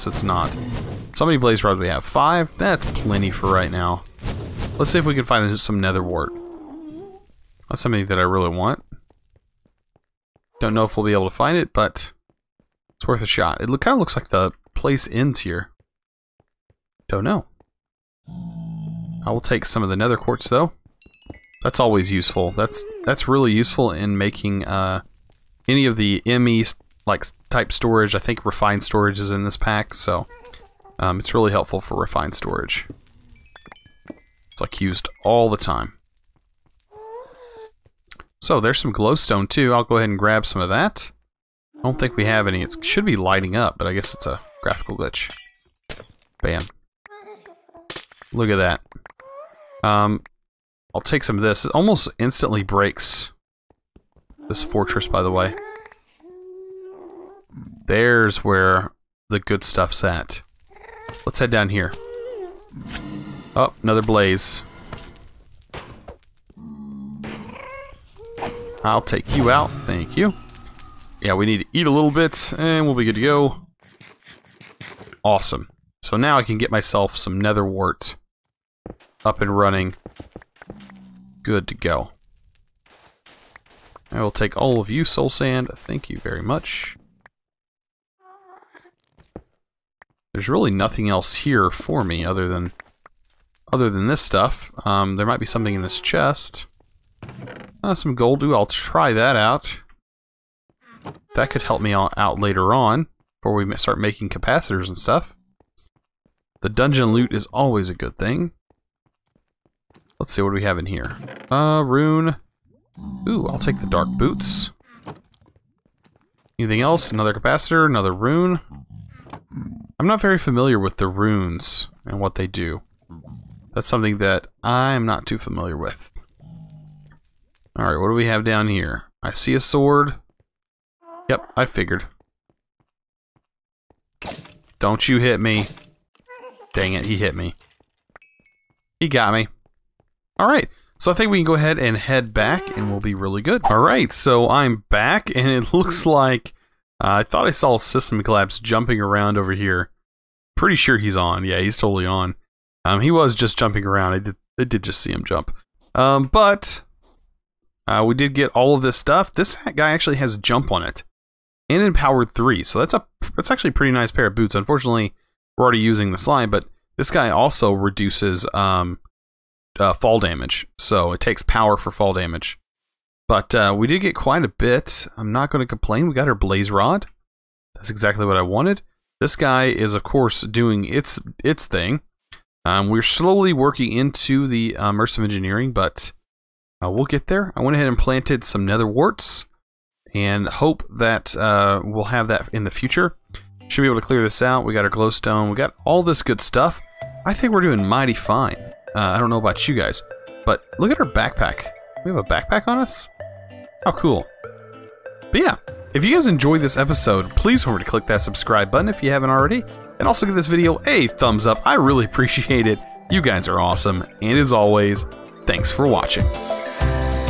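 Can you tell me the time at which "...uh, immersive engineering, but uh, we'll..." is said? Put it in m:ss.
3:04.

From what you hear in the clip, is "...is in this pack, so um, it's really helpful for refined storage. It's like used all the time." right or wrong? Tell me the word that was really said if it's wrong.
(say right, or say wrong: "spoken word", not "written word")
right.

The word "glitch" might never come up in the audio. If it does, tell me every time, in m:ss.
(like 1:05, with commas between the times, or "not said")
0:44.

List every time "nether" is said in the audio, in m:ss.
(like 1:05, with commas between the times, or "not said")
0:05, 0:19, 1:17, 3:08.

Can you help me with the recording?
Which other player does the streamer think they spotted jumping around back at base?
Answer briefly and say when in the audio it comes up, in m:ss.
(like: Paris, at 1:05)
System Collapse, at 2:27.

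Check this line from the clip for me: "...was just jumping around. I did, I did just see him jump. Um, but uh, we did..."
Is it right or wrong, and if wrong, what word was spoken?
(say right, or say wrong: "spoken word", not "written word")
right.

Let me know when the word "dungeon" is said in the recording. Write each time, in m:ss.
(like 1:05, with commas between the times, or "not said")
1:46.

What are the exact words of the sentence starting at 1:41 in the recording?
That could help me out later on, before we start making capacitors and stuff.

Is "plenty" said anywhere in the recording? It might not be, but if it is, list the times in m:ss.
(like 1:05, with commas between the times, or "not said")
0:02.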